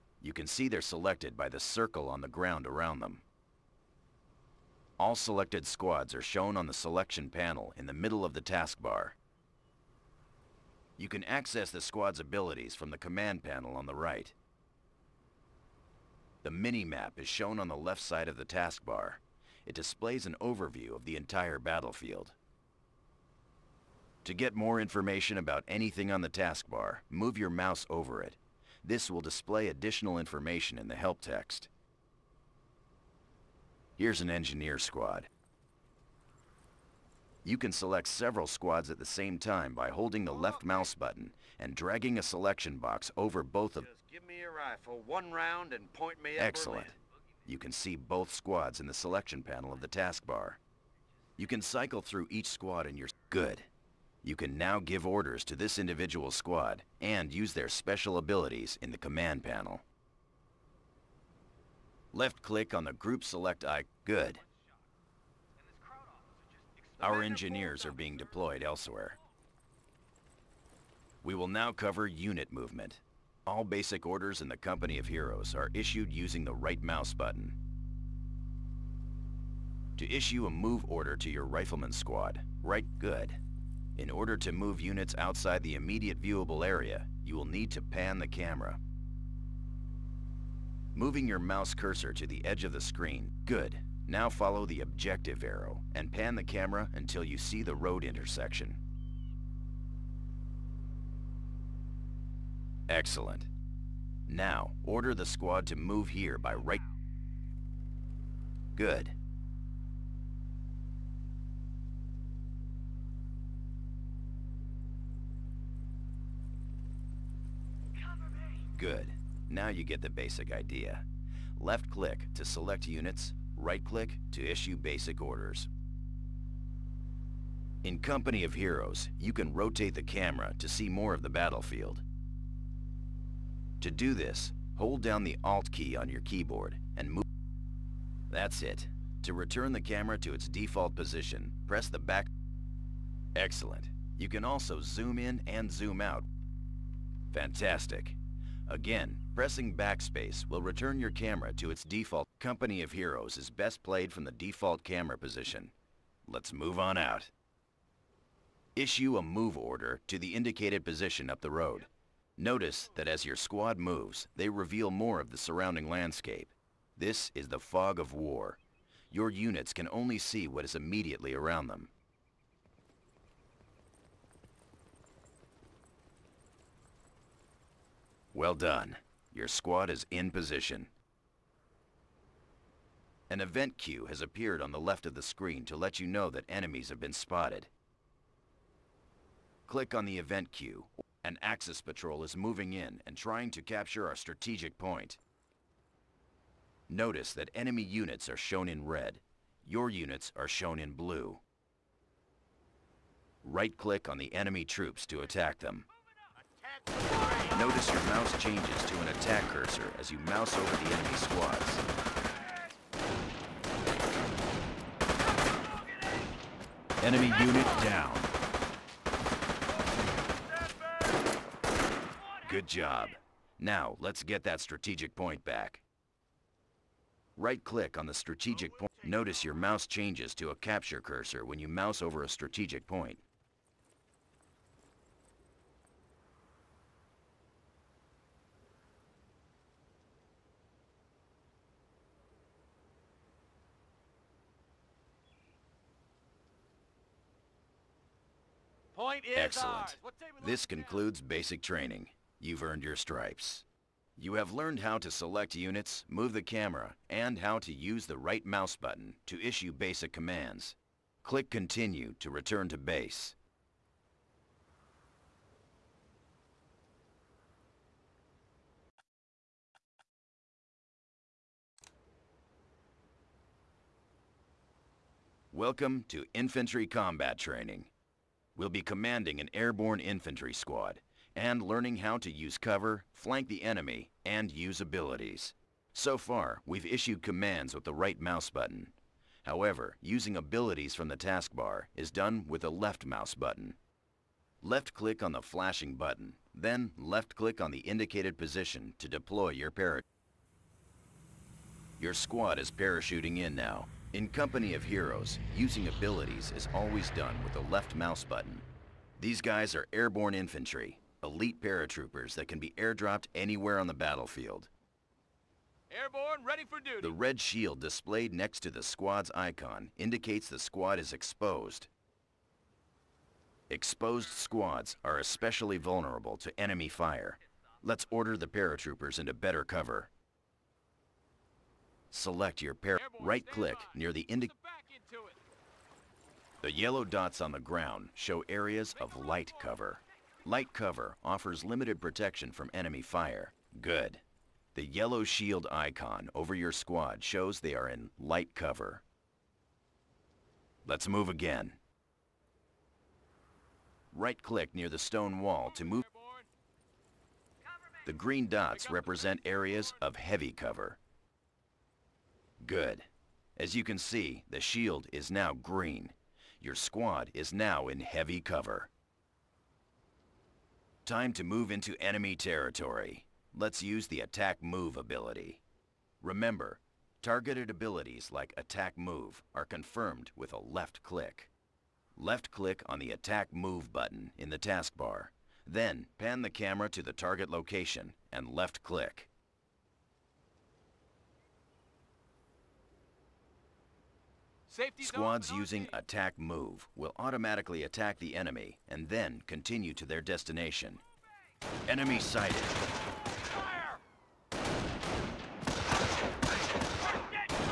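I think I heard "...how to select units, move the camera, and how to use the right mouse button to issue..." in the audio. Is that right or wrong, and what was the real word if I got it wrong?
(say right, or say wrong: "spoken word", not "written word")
right.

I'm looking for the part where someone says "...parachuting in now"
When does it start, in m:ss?
5:02.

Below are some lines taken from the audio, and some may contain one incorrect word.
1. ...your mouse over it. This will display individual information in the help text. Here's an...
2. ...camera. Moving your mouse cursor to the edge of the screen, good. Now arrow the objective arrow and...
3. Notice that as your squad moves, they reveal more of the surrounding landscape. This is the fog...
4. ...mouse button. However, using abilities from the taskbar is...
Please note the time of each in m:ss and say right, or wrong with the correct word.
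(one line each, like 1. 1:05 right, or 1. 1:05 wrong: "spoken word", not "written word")
1. 0:27 wrong: "additional", not "individual"
2. 1:28 wrong: "follow", not "arrow"
3. 2:42 right
4. 4:48 right.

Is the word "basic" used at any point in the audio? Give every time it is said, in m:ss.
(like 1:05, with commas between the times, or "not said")
1:13, 2:00, 2:04, 4:11, 4:19.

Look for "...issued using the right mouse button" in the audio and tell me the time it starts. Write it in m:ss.
1:15.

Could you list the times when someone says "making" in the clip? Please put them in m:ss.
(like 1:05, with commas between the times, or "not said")
not said.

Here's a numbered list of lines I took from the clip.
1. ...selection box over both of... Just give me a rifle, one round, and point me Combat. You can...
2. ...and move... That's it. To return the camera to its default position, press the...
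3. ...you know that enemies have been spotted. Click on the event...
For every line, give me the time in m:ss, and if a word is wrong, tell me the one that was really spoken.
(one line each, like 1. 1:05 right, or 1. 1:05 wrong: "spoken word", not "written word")
1. 0:42 wrong: "Excellent", not "Combat"
2. 2:16 right
3. 3:05 right.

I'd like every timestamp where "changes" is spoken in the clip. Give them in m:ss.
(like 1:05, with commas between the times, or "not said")
3:28, 3:49.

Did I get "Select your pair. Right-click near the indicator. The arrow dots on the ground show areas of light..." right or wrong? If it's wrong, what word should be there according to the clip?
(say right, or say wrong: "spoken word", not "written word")
wrong: "yellow", not "arrow".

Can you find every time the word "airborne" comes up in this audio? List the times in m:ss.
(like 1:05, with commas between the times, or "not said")
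4:39, 5:09, 5:15.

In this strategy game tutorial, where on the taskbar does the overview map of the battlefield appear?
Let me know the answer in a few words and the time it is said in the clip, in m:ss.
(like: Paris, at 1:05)
Left side, at 0:17.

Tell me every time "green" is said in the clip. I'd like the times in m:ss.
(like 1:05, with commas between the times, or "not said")
5:58, 6:05.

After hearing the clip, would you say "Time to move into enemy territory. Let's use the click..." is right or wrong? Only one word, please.
wrong.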